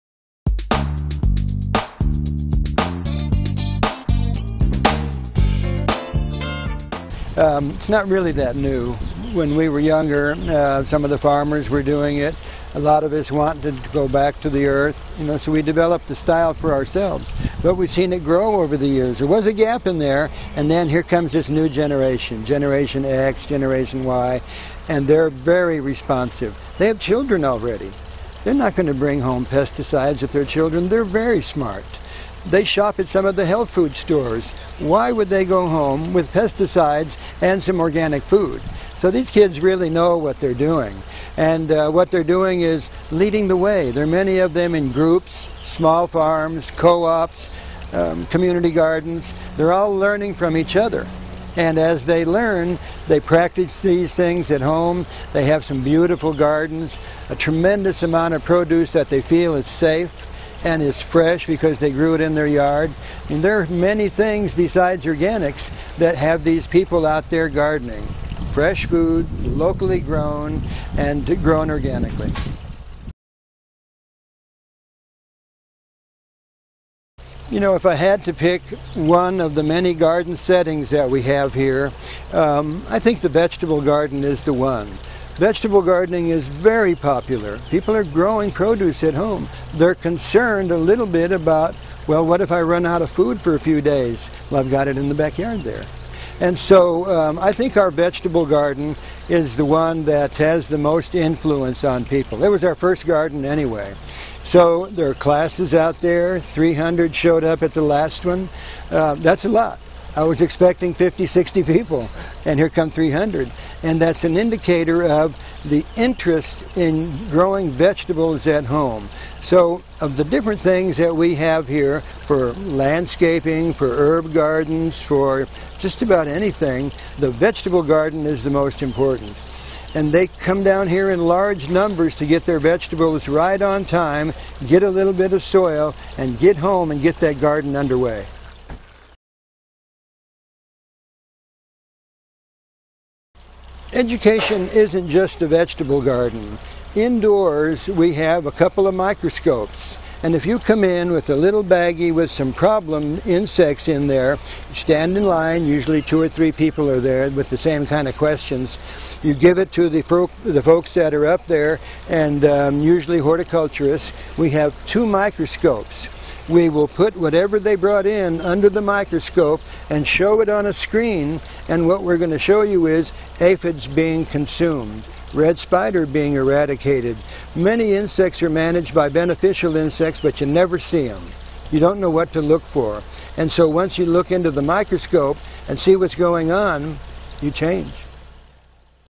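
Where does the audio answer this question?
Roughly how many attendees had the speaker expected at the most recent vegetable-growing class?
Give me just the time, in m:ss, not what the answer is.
1:50.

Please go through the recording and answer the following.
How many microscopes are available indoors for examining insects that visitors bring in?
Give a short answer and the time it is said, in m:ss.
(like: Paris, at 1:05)
2, at 2:44.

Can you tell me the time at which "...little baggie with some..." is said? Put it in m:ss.
2:31.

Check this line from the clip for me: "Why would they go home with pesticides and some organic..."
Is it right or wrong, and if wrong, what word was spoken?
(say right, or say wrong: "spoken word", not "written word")
right.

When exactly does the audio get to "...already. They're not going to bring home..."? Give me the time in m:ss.
0:27.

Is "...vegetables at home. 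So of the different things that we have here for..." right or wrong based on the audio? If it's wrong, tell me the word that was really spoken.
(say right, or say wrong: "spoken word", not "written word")
right.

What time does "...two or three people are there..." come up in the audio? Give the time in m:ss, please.
2:36.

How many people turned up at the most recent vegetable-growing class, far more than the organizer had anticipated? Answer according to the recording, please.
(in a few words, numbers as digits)
300.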